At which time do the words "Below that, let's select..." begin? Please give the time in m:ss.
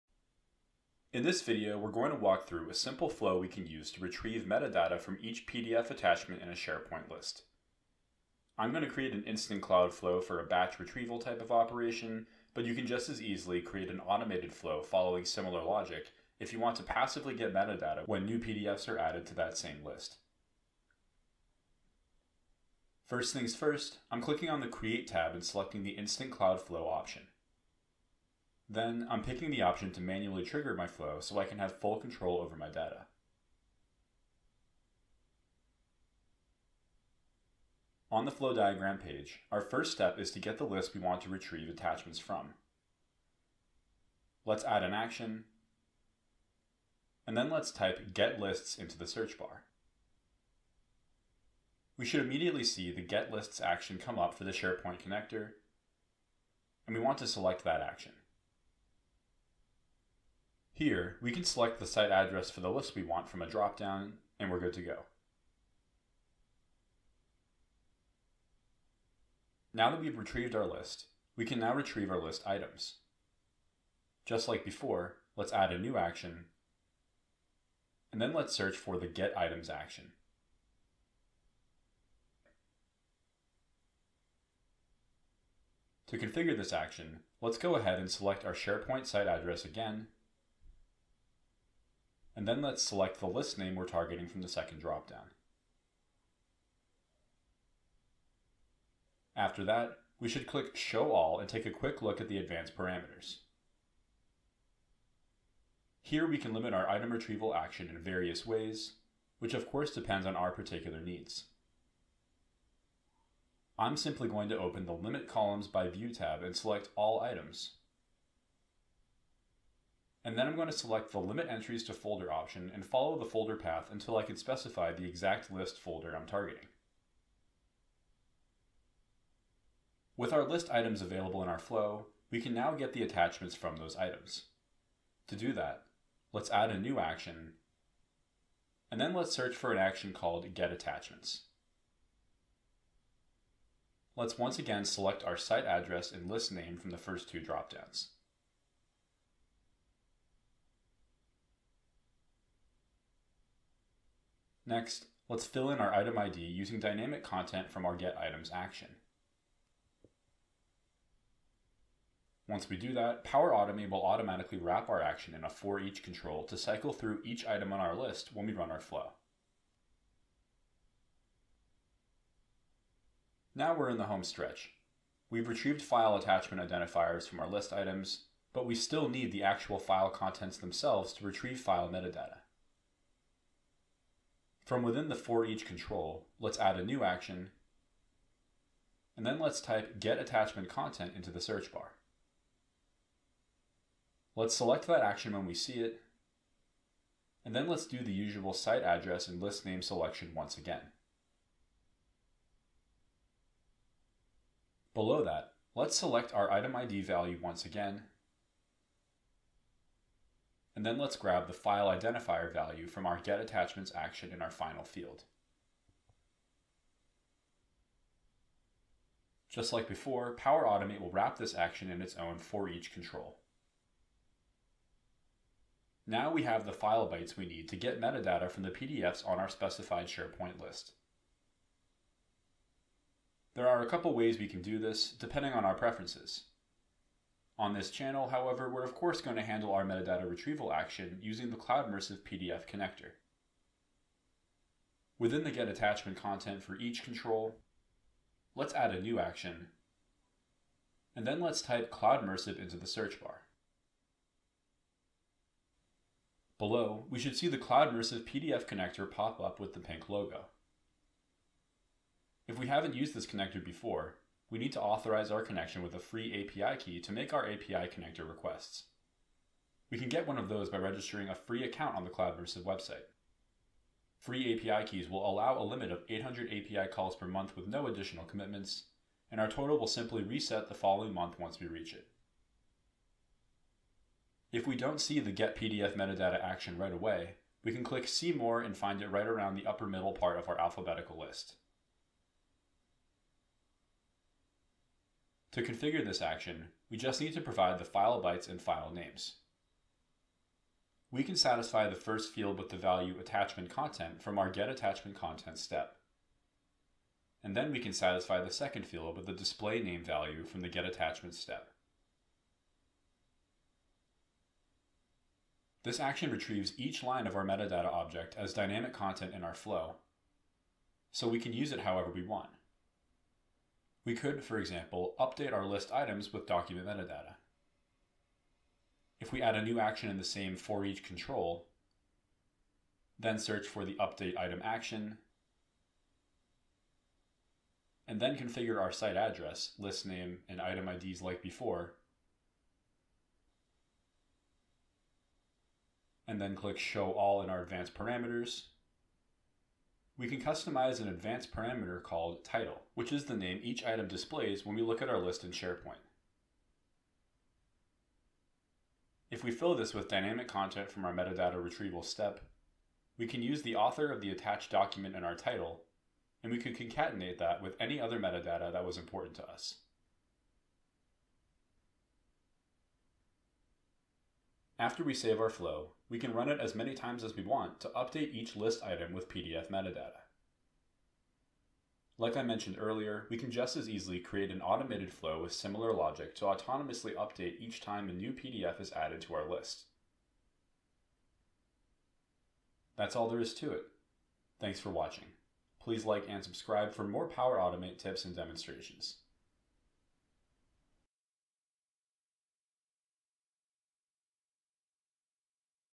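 3:24.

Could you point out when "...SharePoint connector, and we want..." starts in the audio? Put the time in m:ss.
0:54.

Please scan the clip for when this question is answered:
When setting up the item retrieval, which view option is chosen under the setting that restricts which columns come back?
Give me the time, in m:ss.
1:56.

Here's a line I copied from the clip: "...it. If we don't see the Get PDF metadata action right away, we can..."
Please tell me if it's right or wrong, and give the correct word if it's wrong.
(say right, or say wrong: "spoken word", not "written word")
right.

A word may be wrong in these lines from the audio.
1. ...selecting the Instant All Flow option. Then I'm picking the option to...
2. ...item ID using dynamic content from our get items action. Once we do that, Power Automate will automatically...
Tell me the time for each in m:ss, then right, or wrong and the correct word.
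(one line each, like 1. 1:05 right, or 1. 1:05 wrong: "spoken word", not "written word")
1. 0:25 wrong: "Cloud", not "All"
2. 2:35 right.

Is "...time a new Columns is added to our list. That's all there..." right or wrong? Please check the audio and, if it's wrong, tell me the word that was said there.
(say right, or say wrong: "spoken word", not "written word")
wrong: "PDF", not "Columns".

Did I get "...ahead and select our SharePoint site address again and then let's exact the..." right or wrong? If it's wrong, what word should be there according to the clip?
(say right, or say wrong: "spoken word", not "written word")
wrong: "select", not "exact".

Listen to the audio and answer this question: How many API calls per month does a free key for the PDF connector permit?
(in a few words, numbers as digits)
800.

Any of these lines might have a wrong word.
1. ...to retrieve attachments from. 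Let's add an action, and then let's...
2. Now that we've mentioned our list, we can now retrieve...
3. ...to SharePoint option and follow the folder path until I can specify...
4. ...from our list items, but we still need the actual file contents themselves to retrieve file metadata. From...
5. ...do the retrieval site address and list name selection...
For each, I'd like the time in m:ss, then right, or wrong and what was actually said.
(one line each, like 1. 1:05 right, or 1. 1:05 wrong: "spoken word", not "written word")
1. 0:41 right
2. 1:09 wrong: "retrieved", not "mentioned"
3. 2:01 wrong: "Folder", not "SharePoint"
4. 2:57 right
5. 3:17 wrong: "usual", not "retrieval".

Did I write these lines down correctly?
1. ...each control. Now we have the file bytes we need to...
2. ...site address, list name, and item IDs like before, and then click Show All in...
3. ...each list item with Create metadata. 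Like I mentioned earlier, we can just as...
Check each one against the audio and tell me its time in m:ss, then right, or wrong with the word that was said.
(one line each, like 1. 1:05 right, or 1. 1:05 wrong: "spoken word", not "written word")
1. 3:42 right
2. 5:38 right
3. 6:18 wrong: "PDF", not "Create".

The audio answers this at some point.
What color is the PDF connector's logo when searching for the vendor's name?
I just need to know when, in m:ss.
4:19.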